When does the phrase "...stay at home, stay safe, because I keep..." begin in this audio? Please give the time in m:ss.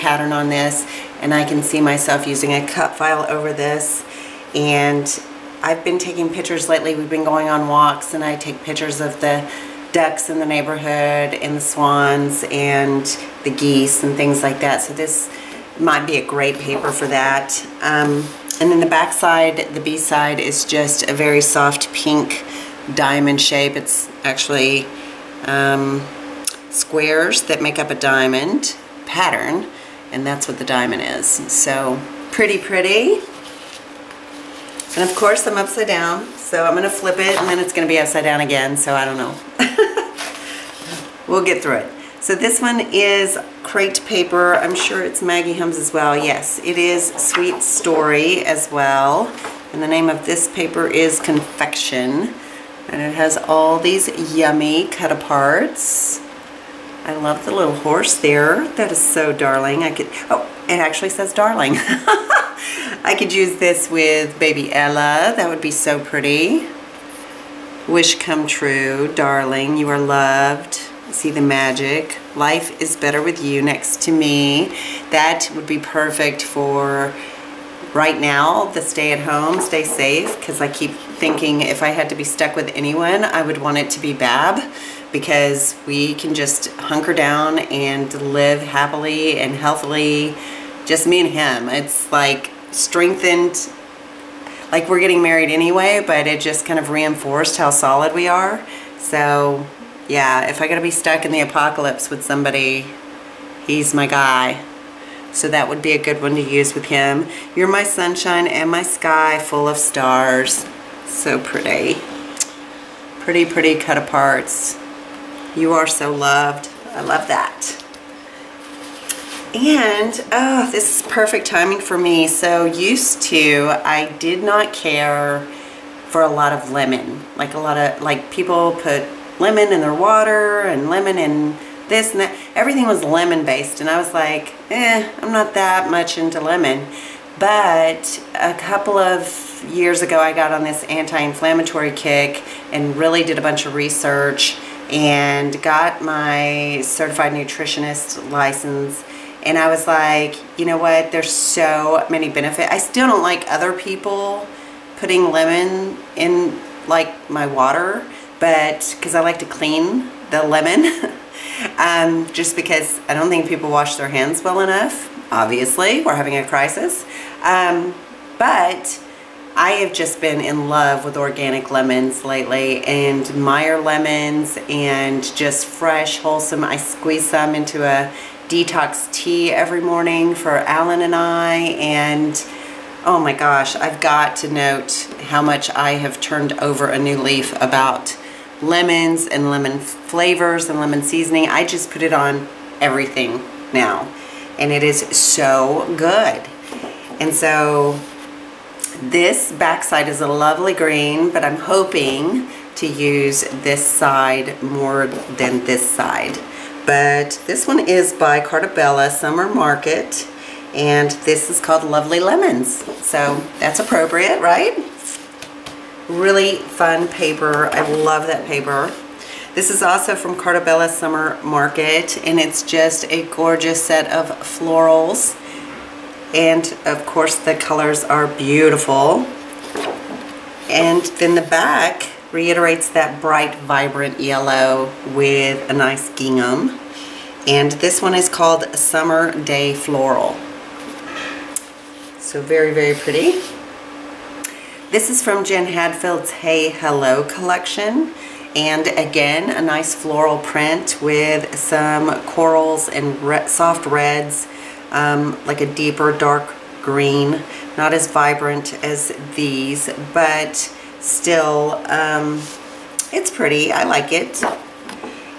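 1:18.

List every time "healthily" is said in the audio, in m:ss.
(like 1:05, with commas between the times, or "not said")
1:29.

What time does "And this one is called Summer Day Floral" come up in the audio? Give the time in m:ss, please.
3:57.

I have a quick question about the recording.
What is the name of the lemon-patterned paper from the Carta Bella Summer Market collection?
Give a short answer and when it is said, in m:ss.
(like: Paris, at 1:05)
Lovely Lemons, at 3:31.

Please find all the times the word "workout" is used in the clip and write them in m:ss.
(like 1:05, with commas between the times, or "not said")
not said.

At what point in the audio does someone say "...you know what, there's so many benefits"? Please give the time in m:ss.
2:30.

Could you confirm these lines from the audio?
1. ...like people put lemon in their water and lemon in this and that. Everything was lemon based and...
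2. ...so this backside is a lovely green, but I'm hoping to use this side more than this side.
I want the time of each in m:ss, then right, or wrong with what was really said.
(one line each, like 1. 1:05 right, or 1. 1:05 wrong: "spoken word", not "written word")
1. 2:08 right
2. 3:17 right.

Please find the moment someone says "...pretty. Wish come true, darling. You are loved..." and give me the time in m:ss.
1:06.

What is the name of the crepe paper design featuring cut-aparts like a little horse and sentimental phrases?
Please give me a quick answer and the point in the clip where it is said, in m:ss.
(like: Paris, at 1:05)
Confection, at 0:51.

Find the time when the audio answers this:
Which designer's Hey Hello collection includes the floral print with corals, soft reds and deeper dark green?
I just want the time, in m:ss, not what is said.
4:05.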